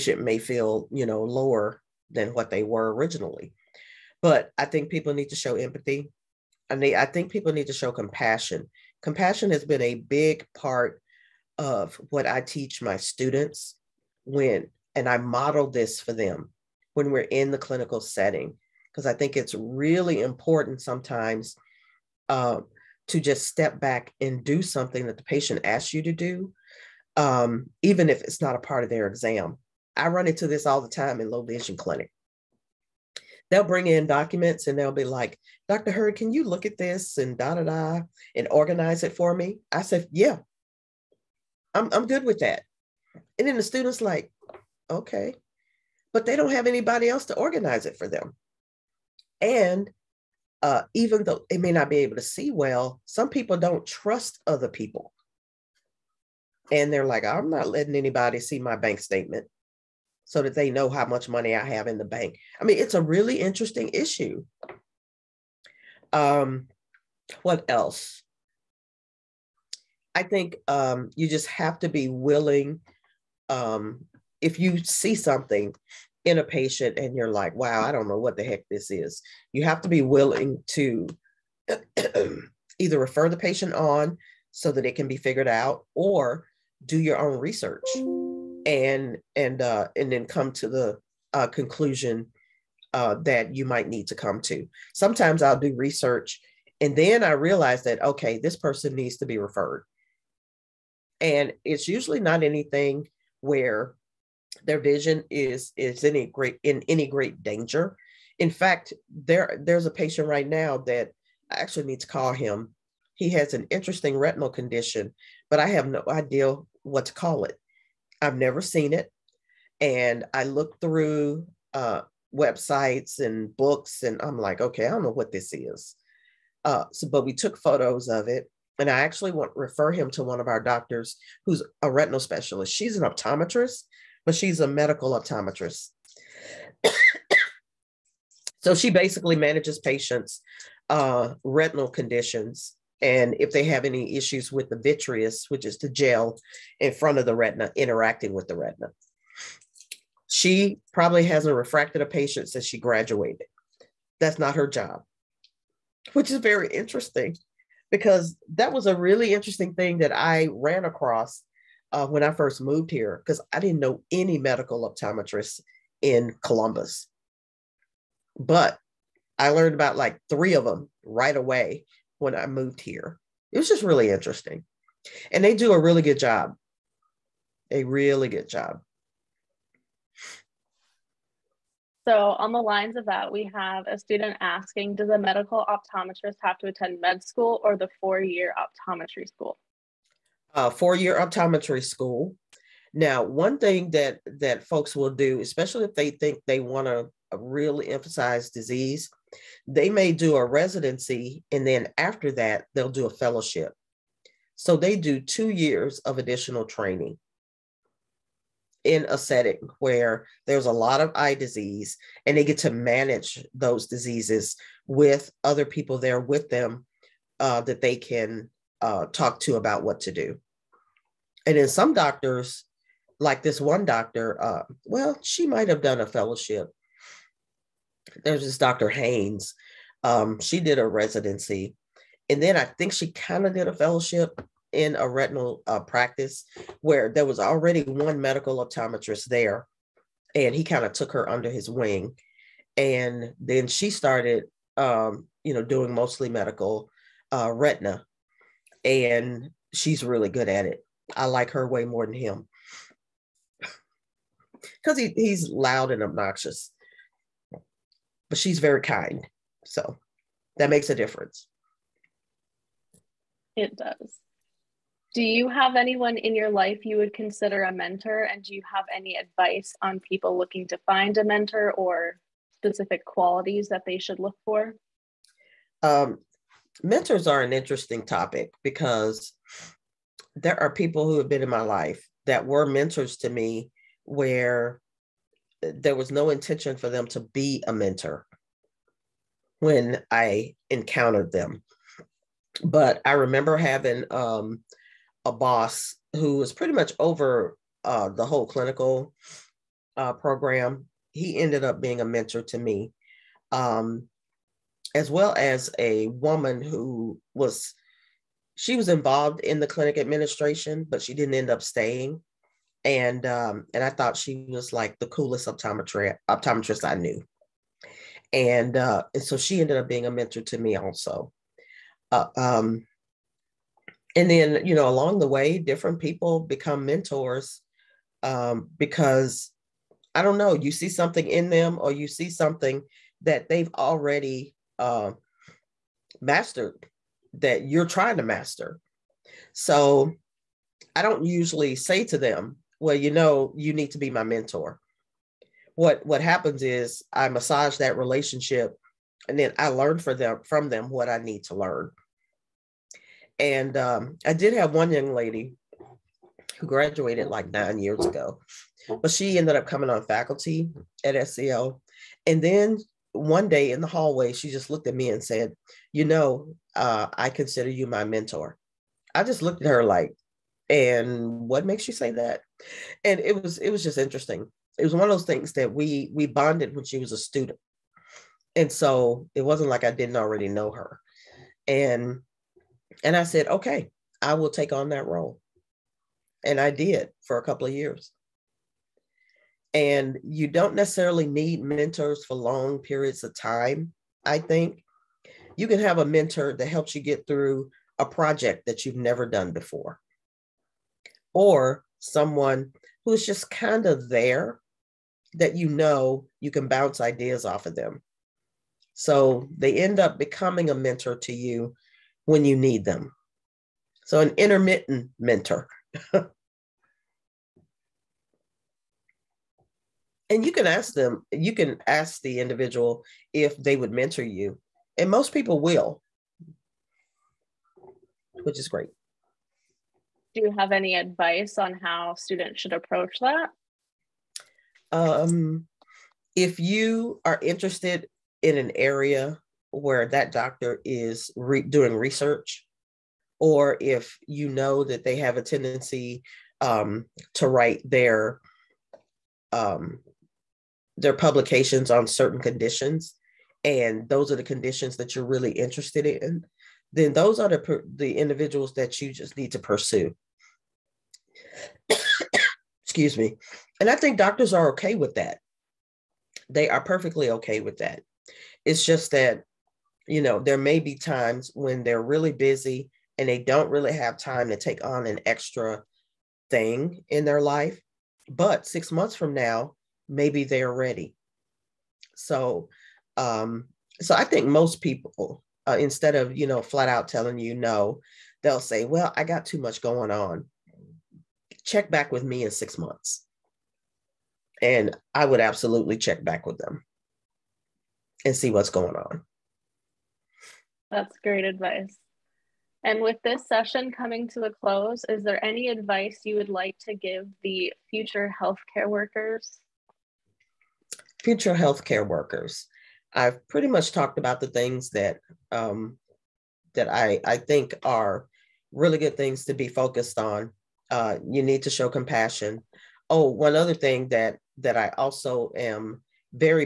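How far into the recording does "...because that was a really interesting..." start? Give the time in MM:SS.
02:37.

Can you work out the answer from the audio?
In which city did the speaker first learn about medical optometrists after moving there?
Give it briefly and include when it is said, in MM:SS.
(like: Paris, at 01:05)
Columbus, at 02:46.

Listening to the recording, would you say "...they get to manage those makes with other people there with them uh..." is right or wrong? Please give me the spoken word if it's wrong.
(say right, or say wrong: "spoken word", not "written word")
wrong: "diseases", not "makes".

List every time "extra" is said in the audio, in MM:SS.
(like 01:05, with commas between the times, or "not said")
07:55.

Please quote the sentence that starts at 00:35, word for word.
Heard, can you look at this and da da da and organize it for me?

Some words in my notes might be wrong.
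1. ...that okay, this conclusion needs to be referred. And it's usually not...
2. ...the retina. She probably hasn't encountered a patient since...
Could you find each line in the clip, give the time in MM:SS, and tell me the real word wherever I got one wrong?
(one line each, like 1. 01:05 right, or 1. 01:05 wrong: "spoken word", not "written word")
1. 01:37 wrong: "person", not "conclusion"
2. 02:28 wrong: "refracted", not "encountered".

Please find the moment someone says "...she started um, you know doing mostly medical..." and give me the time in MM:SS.
04:03.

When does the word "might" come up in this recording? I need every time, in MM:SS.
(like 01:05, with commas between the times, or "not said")
01:33, 03:45.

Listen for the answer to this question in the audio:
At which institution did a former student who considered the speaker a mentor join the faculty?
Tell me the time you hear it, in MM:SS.
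06:01.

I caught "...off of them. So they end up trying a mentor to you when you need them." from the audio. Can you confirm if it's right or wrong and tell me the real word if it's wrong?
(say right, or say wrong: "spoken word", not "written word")
wrong: "becoming", not "trying".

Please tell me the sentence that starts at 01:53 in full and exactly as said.
He has an interesting retinal condition, but I have no idea what to call it.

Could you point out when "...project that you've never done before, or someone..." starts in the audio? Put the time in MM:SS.
06:38.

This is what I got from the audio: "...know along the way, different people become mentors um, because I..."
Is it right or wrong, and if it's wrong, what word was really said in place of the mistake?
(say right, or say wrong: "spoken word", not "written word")
right.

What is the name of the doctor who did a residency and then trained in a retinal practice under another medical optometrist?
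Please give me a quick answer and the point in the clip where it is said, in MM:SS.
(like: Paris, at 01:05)
Dr. Haynes, at 03:48.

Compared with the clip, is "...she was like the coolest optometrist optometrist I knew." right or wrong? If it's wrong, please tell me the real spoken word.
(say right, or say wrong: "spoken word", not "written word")
right.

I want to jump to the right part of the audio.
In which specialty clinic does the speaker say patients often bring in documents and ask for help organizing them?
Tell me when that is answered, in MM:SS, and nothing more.
00:31.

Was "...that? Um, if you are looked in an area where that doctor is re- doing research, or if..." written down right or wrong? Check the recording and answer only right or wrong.
wrong.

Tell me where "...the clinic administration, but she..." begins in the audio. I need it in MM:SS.
05:09.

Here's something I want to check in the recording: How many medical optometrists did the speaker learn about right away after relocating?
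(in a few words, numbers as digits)
3.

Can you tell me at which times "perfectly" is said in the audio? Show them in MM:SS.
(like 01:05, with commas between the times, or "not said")
07:46.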